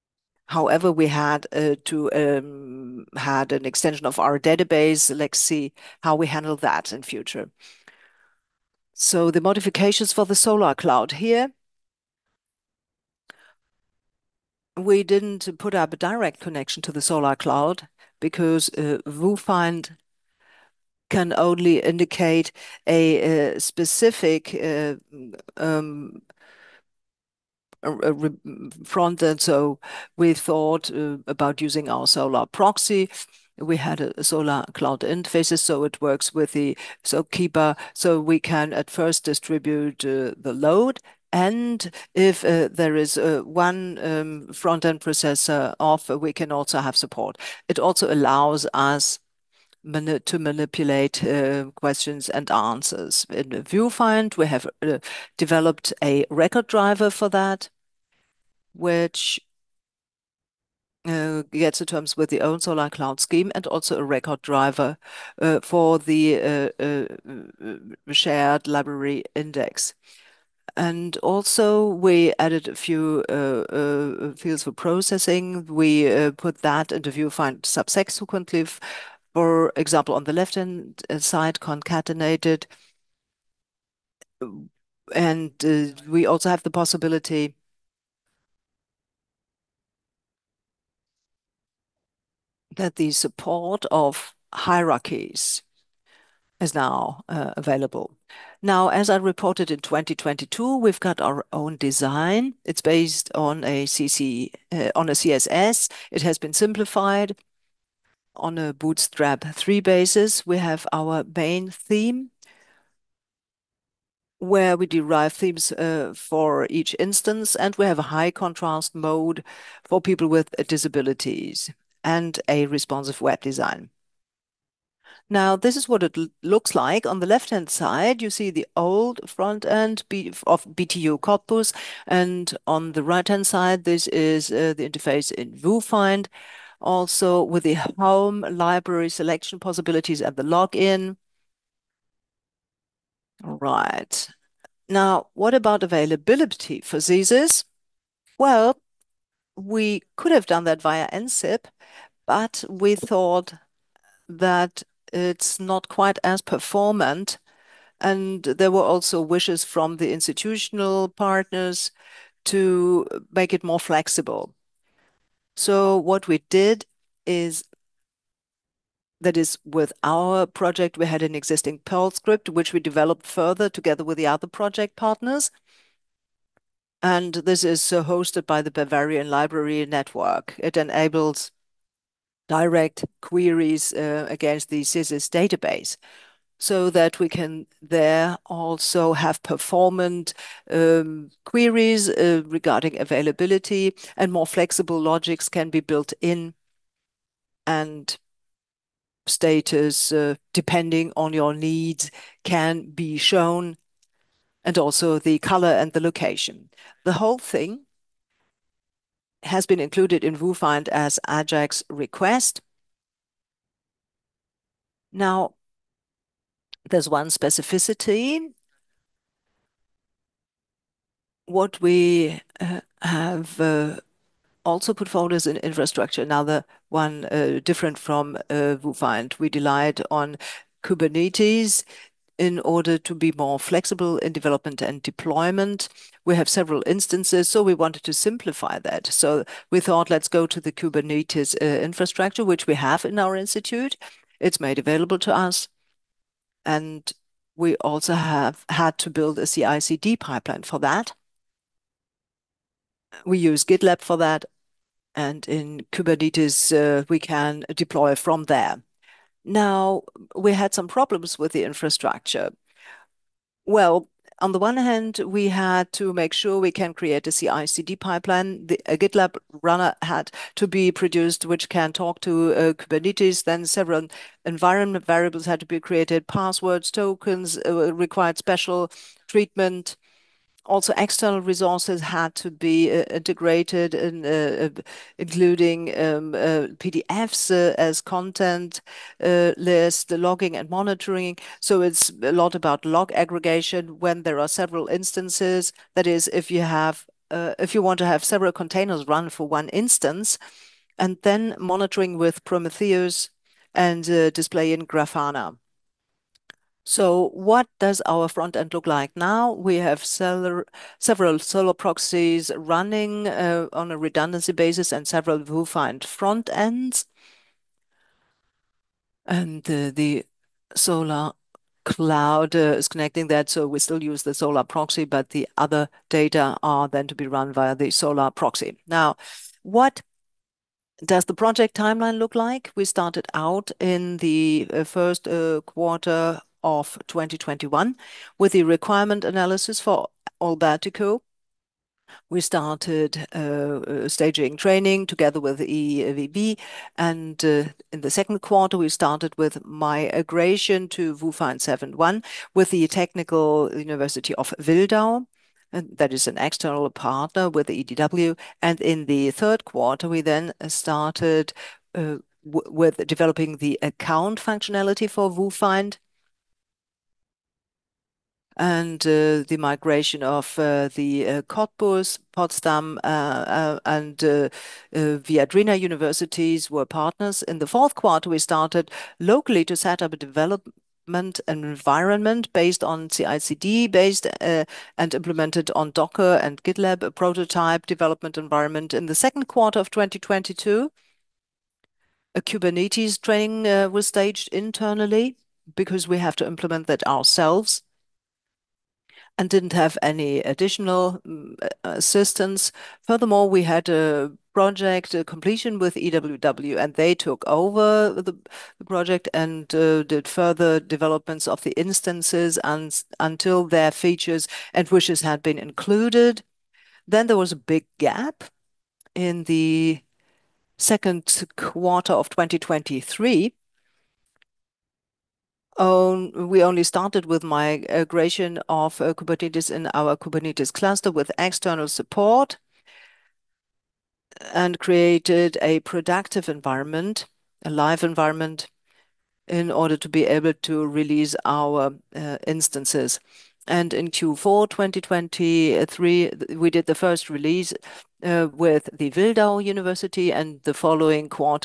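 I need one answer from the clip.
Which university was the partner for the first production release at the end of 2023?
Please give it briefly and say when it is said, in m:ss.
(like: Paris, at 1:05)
Wildau University, at 7:29.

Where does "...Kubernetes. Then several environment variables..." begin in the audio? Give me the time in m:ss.
4:32.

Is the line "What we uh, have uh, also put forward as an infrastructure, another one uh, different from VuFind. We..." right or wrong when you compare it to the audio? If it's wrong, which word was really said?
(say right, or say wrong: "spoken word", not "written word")
right.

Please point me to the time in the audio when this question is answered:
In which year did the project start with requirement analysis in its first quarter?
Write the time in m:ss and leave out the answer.
5:37.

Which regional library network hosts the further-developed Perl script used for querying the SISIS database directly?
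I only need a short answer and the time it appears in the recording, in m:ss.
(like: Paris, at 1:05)
Bavarian Library Network, at 2:58.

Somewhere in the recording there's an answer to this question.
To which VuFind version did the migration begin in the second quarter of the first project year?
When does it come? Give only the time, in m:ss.
5:51.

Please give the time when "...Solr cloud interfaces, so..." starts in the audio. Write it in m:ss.
0:34.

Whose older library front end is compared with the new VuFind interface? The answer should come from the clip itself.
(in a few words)
BTU Cottbus.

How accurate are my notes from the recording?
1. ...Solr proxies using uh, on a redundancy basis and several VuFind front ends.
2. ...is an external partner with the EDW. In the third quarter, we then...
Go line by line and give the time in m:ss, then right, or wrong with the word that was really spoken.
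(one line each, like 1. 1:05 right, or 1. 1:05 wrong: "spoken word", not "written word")
1. 5:10 wrong: "running", not "using"
2. 5:56 right.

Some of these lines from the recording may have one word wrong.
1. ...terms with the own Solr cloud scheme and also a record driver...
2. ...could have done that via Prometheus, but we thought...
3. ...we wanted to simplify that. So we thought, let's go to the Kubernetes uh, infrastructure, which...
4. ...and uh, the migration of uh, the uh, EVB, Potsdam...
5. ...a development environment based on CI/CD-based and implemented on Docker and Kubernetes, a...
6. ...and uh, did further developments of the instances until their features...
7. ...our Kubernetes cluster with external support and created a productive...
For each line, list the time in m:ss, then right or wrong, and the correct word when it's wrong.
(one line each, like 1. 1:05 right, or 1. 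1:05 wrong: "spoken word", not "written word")
1. 1:01 right
2. 2:30 wrong: "NCIP", not "Prometheus"
3. 3:57 right
4. 6:08 wrong: "Cottbus", not "EVB"
5. 6:20 wrong: "GitLab", not "Kubernetes"
6. 6:49 right
7. 7:09 right.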